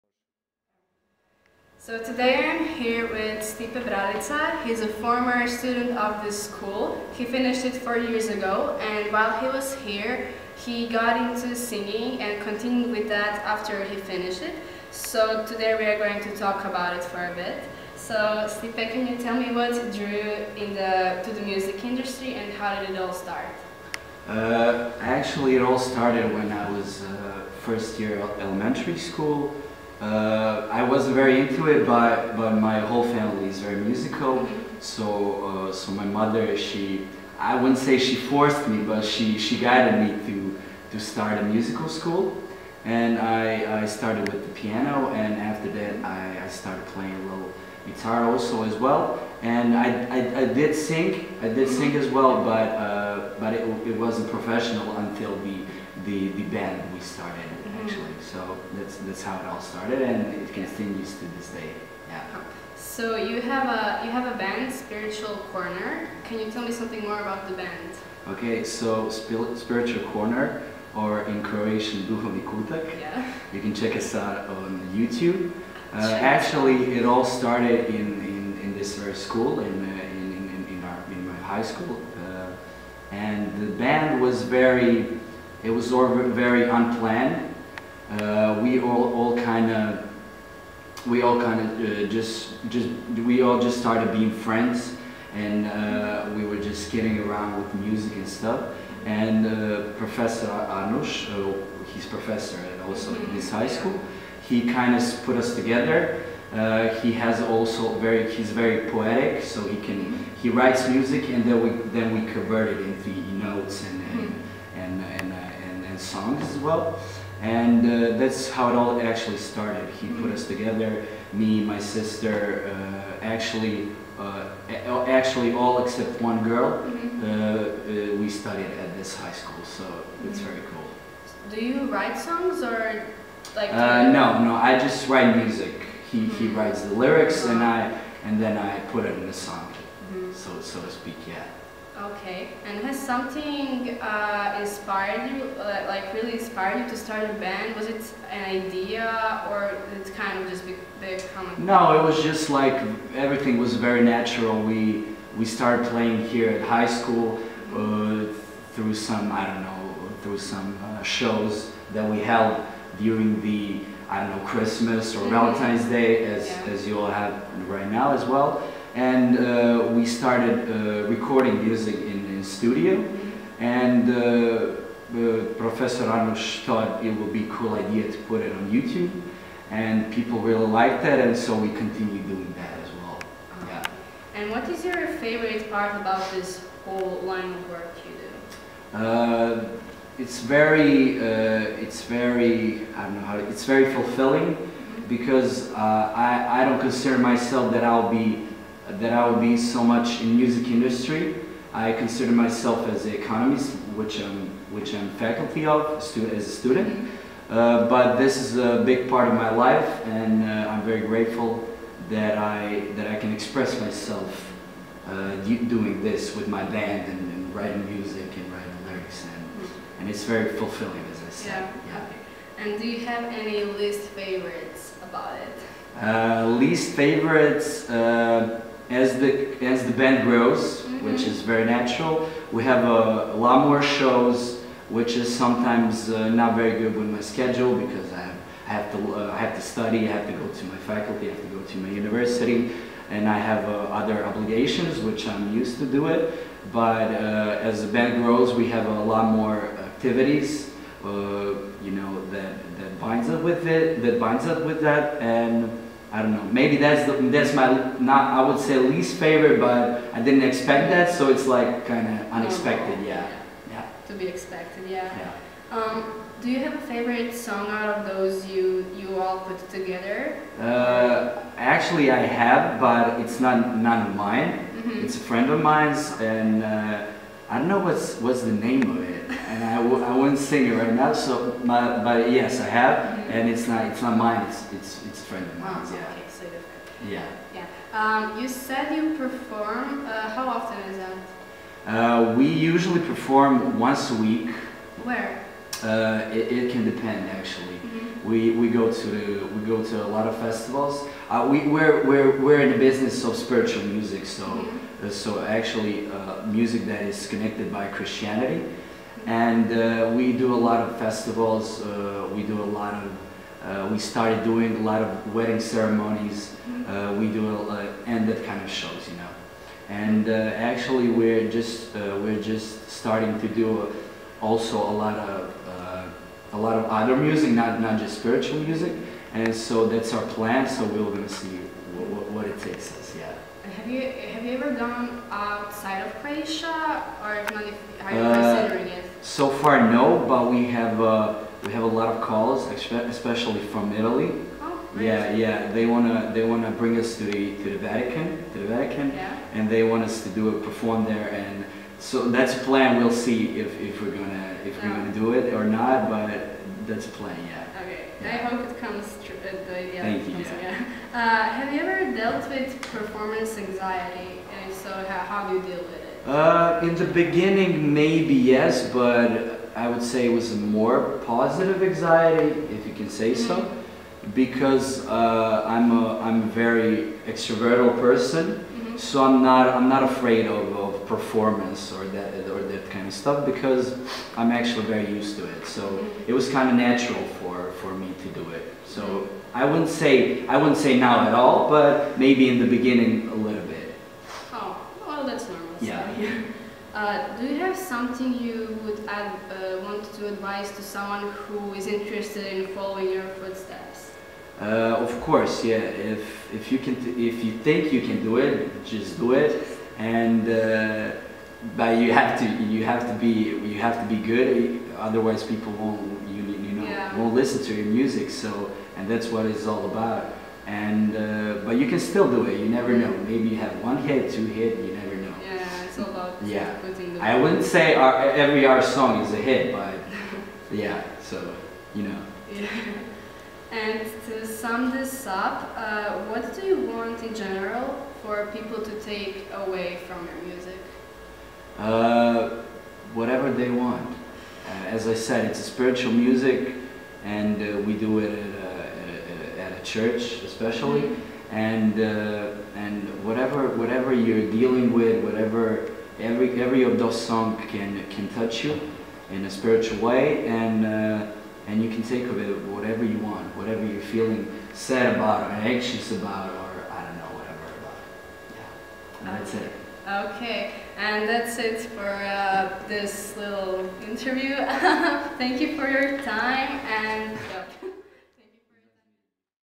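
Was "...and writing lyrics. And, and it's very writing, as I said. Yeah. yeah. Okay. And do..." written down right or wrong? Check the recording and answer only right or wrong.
wrong.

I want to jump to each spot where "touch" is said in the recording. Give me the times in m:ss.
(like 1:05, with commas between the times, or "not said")
7:38.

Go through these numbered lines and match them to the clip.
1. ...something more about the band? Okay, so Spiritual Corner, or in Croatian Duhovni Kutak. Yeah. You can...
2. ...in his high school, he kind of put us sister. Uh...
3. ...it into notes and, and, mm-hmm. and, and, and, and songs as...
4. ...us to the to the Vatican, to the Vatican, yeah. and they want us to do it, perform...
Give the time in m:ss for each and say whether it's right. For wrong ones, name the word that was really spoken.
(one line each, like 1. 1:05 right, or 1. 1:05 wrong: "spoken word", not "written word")
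1. 1:06 right
2. 1:43 wrong: "together", not "sister"
3. 1:52 right
4. 5:46 right.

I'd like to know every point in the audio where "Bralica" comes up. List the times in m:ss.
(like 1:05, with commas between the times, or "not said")
0:03.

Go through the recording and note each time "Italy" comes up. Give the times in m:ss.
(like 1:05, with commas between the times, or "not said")
5:43.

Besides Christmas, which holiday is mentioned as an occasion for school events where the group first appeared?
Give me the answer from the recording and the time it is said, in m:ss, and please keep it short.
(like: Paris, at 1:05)
Valentine's Day, at 2:45.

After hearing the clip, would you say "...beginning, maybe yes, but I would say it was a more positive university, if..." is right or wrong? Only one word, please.
wrong.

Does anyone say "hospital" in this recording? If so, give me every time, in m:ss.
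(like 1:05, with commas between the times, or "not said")
not said.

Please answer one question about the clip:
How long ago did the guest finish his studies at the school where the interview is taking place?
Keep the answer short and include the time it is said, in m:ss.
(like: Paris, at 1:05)
4 years, at 0:07.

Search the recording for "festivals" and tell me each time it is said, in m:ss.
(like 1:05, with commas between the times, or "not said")
5:00, 5:10.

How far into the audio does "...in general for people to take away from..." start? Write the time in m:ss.
7:17.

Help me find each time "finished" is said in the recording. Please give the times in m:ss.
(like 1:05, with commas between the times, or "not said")
0:07, 0:13.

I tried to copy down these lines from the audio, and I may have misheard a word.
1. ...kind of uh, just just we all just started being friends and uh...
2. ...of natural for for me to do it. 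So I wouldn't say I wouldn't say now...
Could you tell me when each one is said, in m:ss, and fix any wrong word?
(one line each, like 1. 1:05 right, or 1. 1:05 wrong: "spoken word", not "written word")
1. 1:31 right
2. 6:26 right.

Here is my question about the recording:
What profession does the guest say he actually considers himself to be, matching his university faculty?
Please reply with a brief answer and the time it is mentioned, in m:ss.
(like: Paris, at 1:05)
Economist, at 3:23.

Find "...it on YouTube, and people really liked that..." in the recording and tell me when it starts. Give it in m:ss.
2:58.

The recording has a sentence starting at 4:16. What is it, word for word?
Maybe that's the, that's my not I would say least favorite, but I didn't expect that, so it's like kind of oh.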